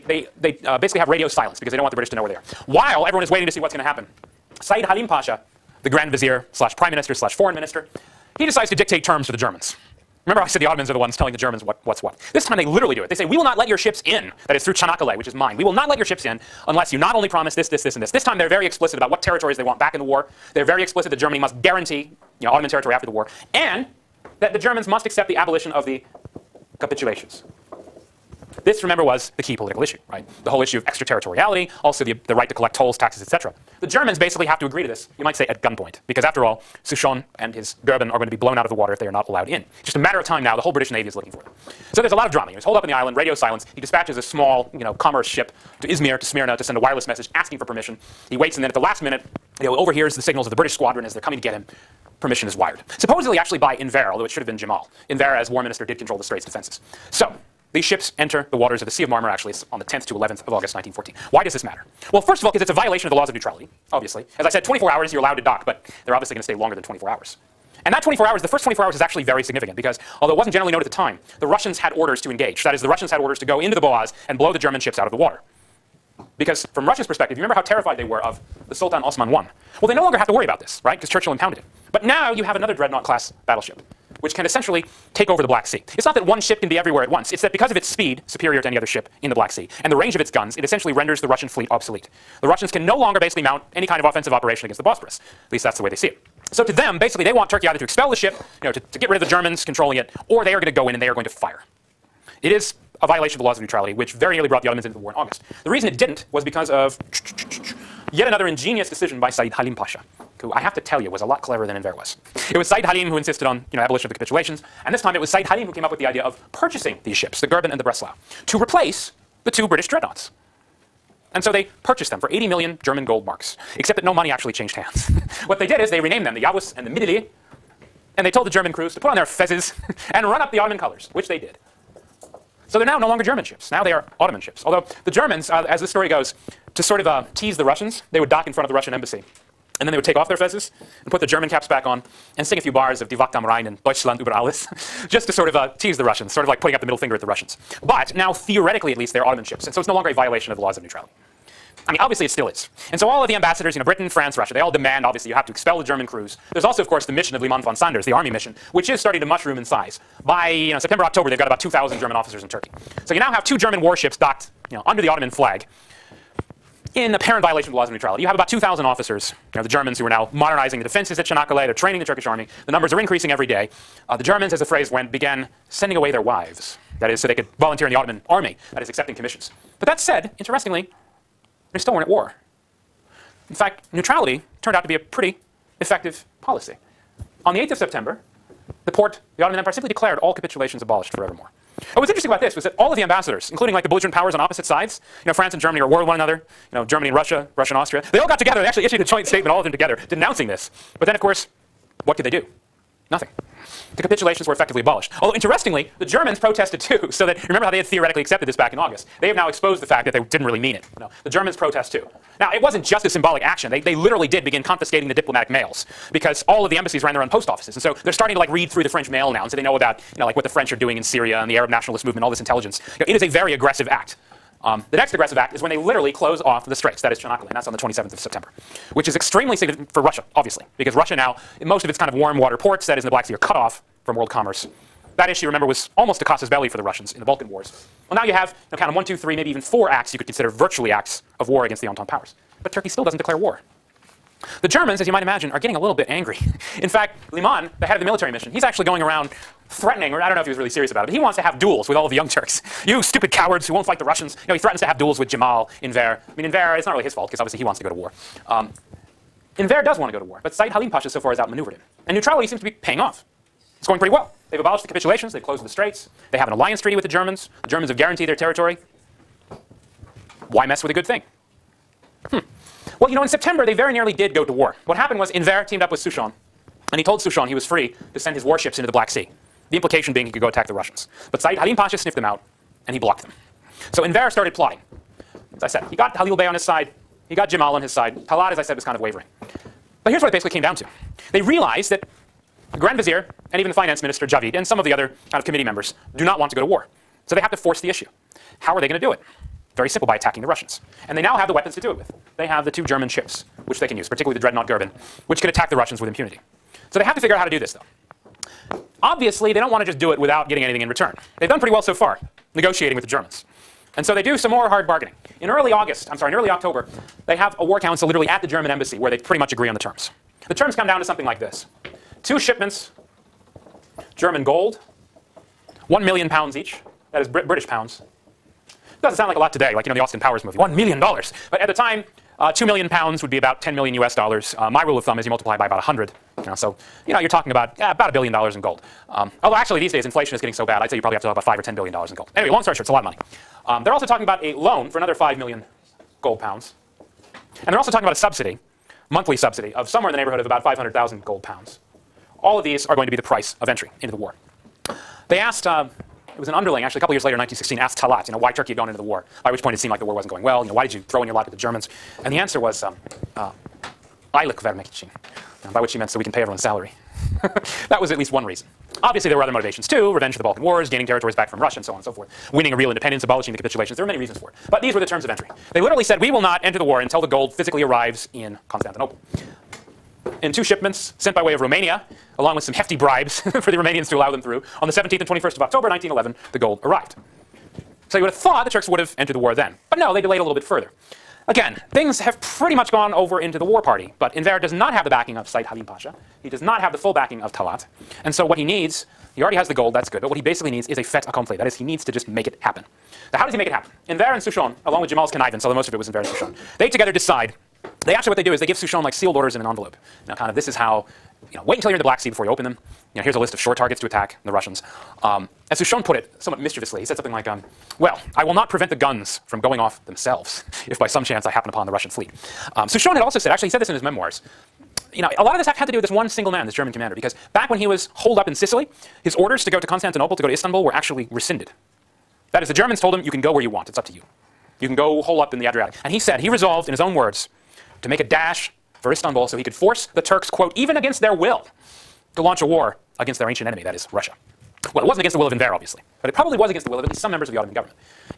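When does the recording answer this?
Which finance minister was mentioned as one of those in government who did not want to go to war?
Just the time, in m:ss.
4:54.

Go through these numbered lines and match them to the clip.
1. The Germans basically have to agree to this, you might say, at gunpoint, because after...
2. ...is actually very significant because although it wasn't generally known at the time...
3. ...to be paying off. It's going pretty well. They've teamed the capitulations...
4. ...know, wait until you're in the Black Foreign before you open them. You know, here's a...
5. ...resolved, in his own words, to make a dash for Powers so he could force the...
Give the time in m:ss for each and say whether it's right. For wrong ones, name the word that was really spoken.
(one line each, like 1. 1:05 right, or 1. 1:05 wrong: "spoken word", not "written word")
1. 0:33 right
2. 1:08 right
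3. 4:22 wrong: "abolished", not "teamed"
4. 6:51 wrong: "Sea", not "Foreign"
5. 7:16 wrong: "Istanbul", not "Powers".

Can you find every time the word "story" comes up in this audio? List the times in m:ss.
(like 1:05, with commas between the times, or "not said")
2:15, 5:42.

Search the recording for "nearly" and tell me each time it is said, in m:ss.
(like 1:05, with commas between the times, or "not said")
1:44, 4:33.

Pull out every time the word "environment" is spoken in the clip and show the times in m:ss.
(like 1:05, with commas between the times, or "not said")
not said.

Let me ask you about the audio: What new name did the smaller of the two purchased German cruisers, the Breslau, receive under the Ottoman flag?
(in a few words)
Midili.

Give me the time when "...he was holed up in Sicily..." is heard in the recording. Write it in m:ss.
7:07.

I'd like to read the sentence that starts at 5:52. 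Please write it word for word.
All of these are going to be the price of entry into the war.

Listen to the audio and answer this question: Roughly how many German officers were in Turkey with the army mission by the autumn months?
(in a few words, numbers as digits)
2,000.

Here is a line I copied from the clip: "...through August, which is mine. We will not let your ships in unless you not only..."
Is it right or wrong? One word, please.
wrong.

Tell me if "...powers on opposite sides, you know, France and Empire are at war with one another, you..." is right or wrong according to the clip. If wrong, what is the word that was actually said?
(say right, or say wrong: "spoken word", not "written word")
wrong: "Germany", not "Empire".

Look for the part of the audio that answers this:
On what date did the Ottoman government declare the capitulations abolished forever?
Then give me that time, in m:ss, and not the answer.
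3:07.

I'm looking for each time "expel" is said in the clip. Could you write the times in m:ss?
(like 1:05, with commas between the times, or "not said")
1:37, 2:35.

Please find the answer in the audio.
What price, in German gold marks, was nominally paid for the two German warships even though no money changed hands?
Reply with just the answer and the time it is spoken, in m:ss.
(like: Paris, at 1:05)
80 million, at 2:02.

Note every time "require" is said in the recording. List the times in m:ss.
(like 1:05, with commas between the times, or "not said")
not said.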